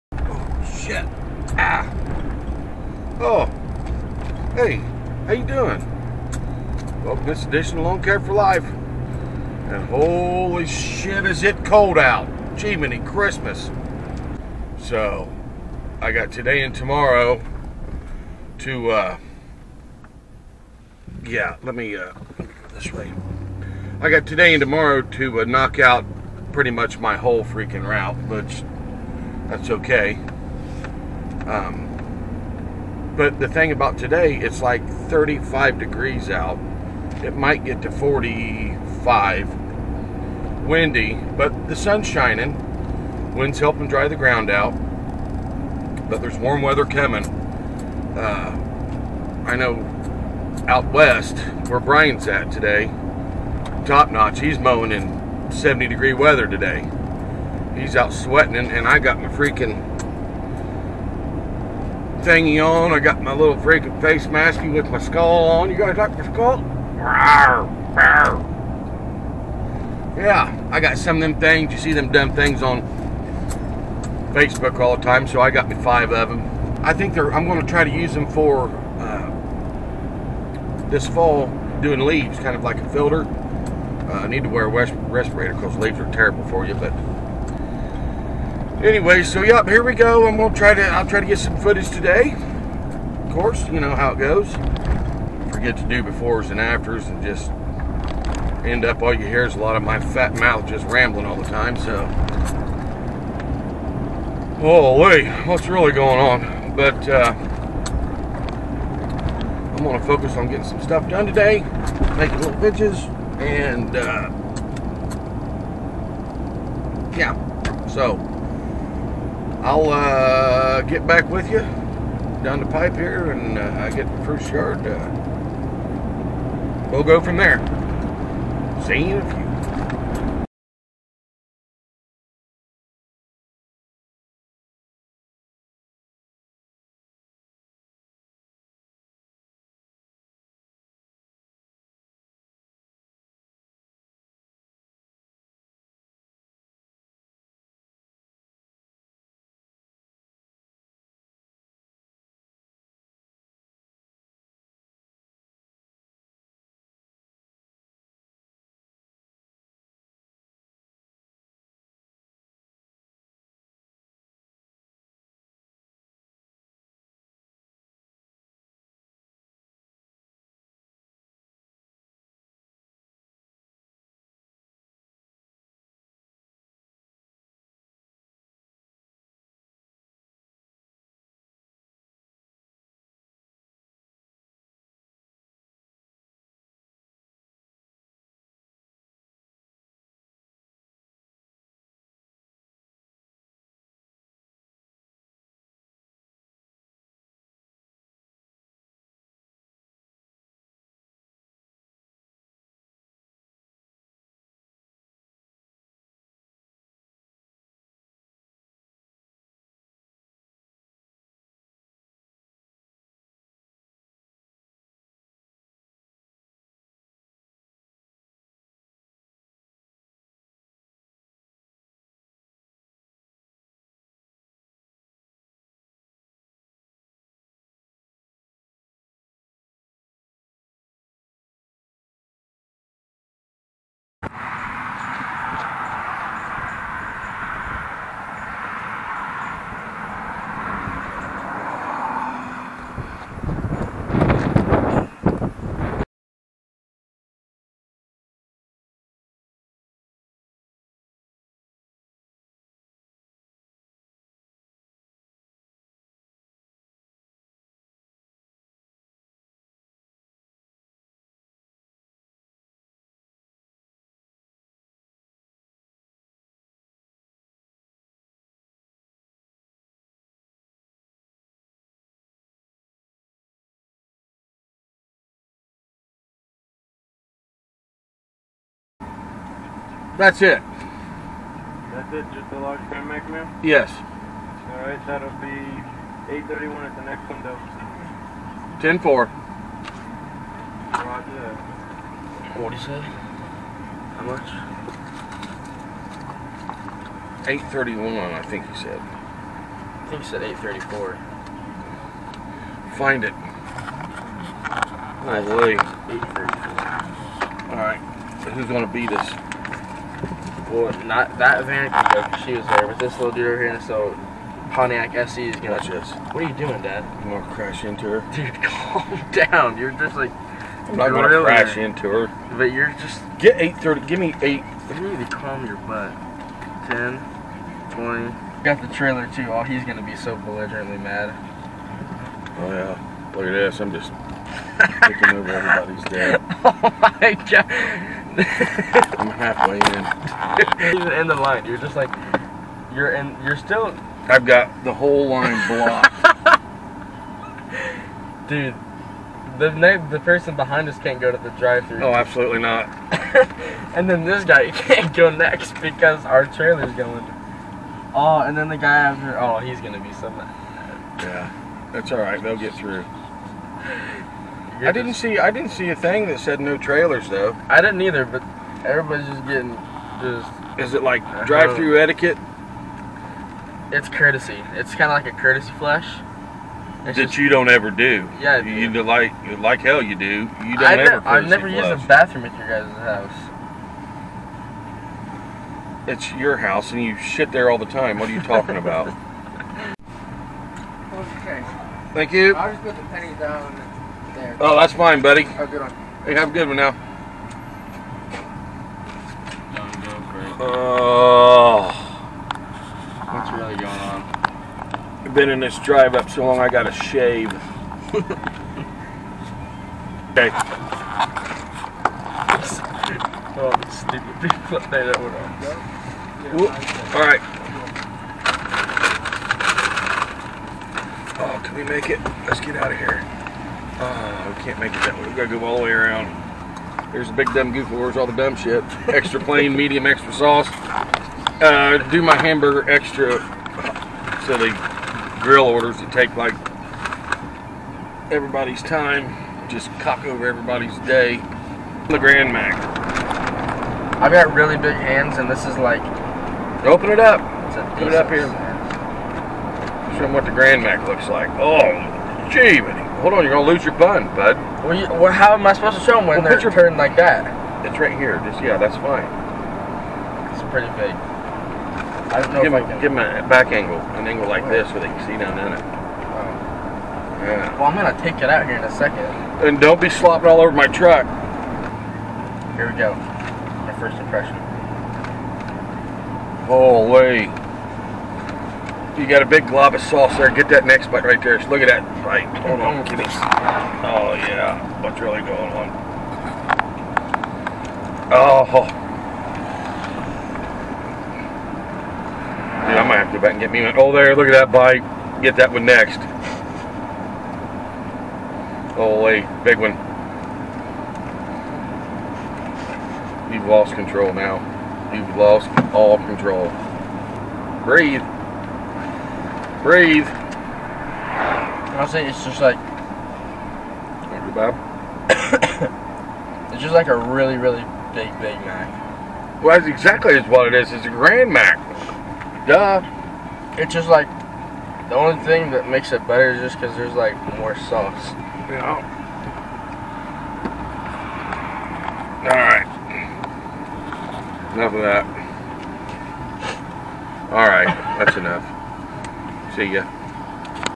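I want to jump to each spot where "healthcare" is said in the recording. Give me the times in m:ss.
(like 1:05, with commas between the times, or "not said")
not said.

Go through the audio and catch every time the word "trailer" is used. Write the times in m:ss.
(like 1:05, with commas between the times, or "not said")
5:28, 5:56, 6:06.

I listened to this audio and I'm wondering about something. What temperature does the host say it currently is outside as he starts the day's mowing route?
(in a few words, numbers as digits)
35 degrees.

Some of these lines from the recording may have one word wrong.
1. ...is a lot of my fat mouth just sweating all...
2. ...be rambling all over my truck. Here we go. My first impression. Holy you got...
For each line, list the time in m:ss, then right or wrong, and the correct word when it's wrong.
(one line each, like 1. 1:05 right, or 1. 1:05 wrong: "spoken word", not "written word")
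1. 1:39 wrong: "rambling", not "sweating"
2. 7:50 wrong: "slopping", not "rambling".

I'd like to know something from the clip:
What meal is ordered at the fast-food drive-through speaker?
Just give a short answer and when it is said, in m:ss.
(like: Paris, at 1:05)
Large Grand Mac meal, at 4:42.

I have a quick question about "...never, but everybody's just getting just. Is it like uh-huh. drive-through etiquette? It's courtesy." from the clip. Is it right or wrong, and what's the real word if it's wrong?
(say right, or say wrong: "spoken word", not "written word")
wrong: "either", not "never".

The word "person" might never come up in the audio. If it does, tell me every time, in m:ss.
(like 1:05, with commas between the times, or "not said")
5:50.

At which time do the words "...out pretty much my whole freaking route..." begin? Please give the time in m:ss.
0:25.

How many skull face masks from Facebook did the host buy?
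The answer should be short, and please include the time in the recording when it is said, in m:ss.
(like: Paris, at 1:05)
5, at 1:15.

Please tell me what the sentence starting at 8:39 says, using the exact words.
Well, that's exactly what it is.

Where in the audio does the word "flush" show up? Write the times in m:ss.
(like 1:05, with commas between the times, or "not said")
6:21.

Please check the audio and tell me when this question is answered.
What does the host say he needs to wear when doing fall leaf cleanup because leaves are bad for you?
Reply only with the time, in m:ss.
1:24.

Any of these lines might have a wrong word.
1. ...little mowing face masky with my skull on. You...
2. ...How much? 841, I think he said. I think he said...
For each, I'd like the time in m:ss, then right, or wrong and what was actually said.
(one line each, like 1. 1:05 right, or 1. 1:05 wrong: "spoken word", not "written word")
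1. 1:03 wrong: "freaking", not "mowing"
2. 4:54 wrong: "831", not "841".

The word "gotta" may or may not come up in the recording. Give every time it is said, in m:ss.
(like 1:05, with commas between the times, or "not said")
6:46, 7:05.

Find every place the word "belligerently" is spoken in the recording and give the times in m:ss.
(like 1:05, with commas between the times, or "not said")
5:30.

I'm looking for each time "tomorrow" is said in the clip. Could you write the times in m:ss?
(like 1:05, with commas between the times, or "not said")
0:16, 0:24.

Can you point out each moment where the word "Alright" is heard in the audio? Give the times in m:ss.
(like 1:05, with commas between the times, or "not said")
4:44, 5:07, 6:57.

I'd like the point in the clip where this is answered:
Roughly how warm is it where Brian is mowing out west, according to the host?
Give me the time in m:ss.
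0:55.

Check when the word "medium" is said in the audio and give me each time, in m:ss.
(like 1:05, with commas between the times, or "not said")
7:09.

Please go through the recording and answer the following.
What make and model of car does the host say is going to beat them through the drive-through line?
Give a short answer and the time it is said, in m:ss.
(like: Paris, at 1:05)
Pontiac SE, at 5:14.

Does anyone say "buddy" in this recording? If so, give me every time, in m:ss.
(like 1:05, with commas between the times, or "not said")
6:35.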